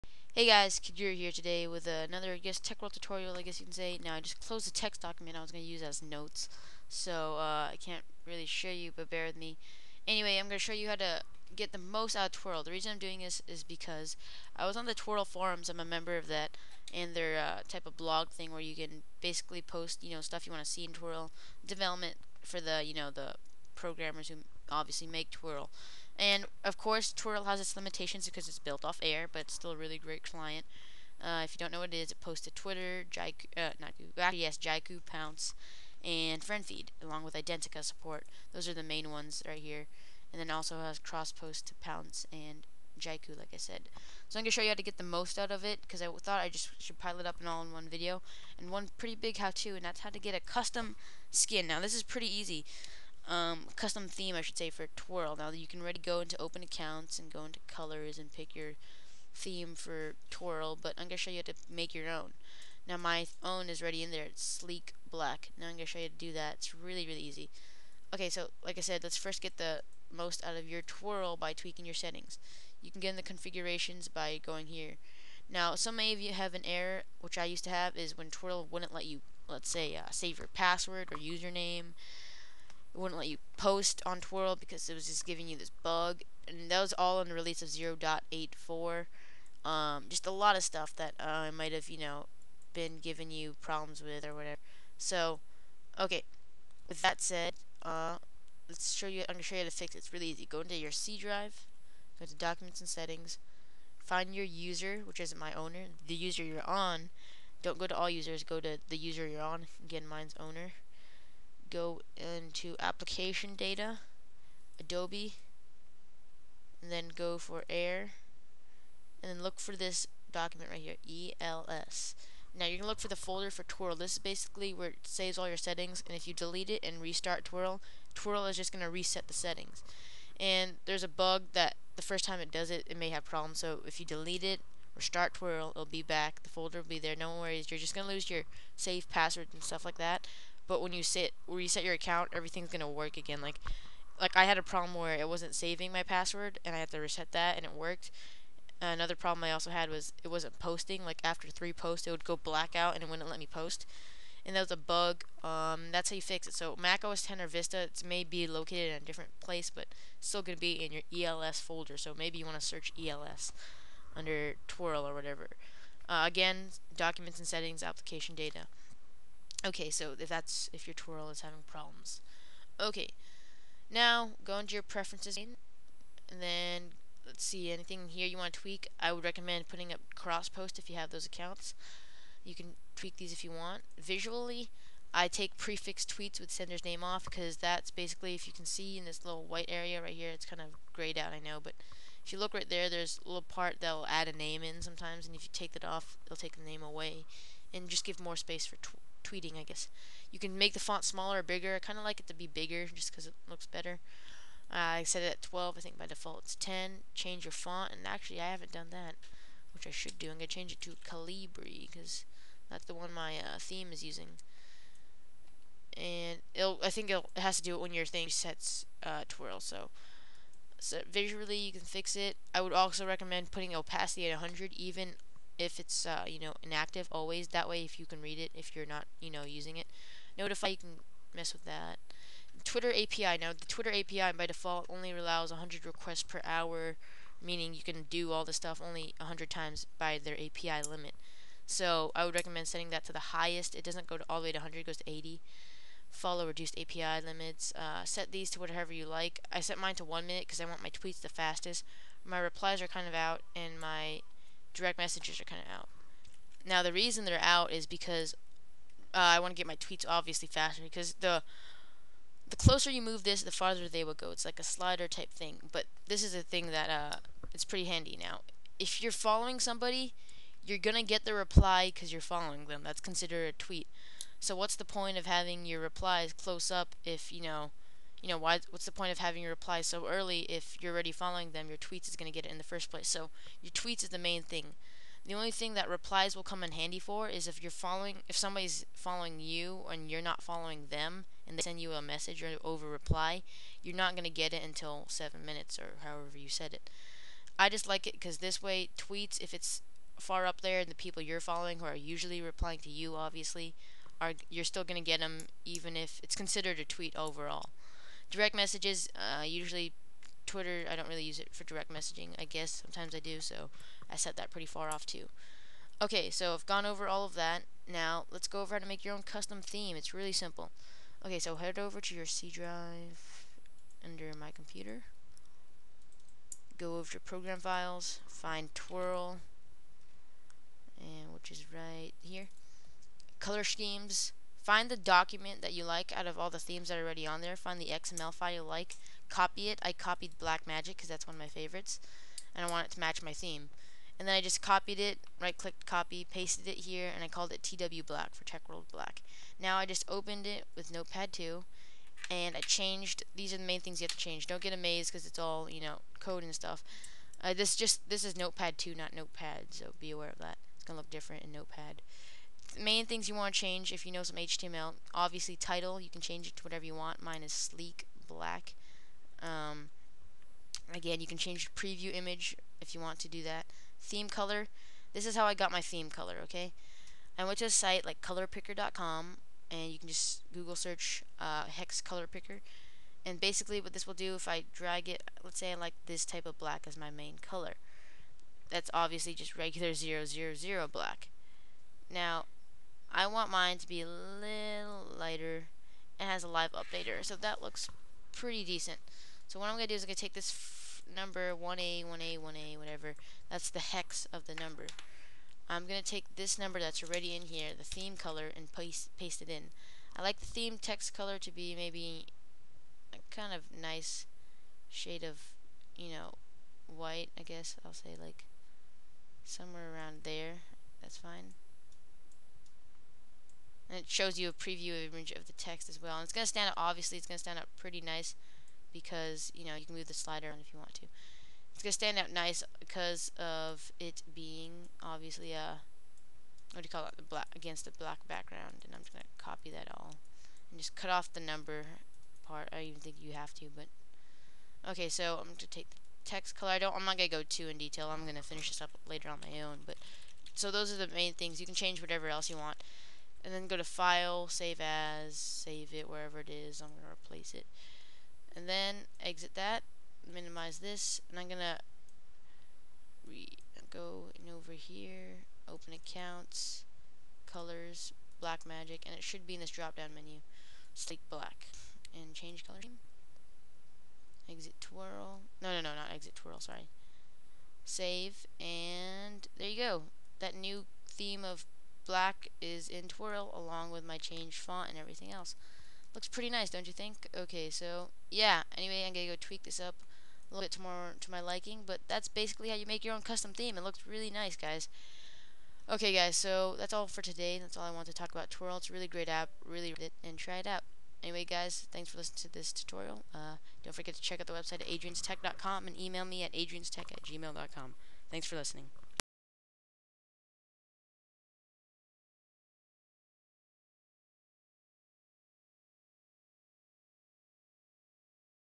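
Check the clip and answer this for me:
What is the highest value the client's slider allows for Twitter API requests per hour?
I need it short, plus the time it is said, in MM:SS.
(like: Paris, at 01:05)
80, at 04:05.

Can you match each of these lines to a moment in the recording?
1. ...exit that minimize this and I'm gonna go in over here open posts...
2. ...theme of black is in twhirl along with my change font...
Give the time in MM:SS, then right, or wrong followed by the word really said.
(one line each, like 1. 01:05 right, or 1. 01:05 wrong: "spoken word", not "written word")
1. 07:39 wrong: "accounts", not "posts"
2. 08:01 right.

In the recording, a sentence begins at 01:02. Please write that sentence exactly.
Now my own is already in there.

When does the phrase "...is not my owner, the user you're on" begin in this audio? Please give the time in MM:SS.
01:45.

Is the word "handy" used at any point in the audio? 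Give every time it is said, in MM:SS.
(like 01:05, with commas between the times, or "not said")
04:27, 04:46.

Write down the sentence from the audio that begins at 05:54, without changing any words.
Don't get amazed because it's all, you know, code and stuff.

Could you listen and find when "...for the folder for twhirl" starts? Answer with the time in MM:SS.
02:02.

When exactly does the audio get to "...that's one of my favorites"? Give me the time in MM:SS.
05:41.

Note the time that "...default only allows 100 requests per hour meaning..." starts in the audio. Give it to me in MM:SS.
03:54.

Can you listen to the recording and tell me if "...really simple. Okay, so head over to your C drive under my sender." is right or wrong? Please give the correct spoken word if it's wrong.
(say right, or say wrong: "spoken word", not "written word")
wrong: "computer", not "sender".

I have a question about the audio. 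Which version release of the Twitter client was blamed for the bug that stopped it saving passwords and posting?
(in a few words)
0.84.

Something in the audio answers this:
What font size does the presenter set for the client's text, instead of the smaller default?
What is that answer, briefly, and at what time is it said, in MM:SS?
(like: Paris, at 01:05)
12, at 03:25.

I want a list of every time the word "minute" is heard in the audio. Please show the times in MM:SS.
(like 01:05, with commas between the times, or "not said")
04:10, 04:55.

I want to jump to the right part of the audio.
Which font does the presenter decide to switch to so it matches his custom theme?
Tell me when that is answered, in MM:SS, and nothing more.
03:31.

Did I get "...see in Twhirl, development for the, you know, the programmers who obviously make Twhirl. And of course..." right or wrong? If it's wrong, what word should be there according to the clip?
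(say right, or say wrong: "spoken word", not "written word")
right.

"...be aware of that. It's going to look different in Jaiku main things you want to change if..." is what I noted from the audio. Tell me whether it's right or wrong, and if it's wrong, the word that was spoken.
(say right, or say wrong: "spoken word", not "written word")
wrong: "Notepad", not "Jaiku".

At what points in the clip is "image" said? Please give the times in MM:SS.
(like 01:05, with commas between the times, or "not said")
06:12, 07:05.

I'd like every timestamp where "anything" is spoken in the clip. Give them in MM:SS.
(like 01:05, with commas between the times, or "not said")
02:57.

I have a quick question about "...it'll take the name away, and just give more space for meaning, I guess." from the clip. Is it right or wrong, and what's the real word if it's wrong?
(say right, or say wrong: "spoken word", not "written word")
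wrong: "tweeting", not "meaning".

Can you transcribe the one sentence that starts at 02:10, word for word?
And there's a bug that the first time it does it, it may have problems.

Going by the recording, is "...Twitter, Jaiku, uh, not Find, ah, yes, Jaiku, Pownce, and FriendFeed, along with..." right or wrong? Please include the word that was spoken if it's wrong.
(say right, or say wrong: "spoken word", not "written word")
wrong: "Google", not "Find".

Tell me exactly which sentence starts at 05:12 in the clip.
Sometimes I do, so I set that pretty far off too.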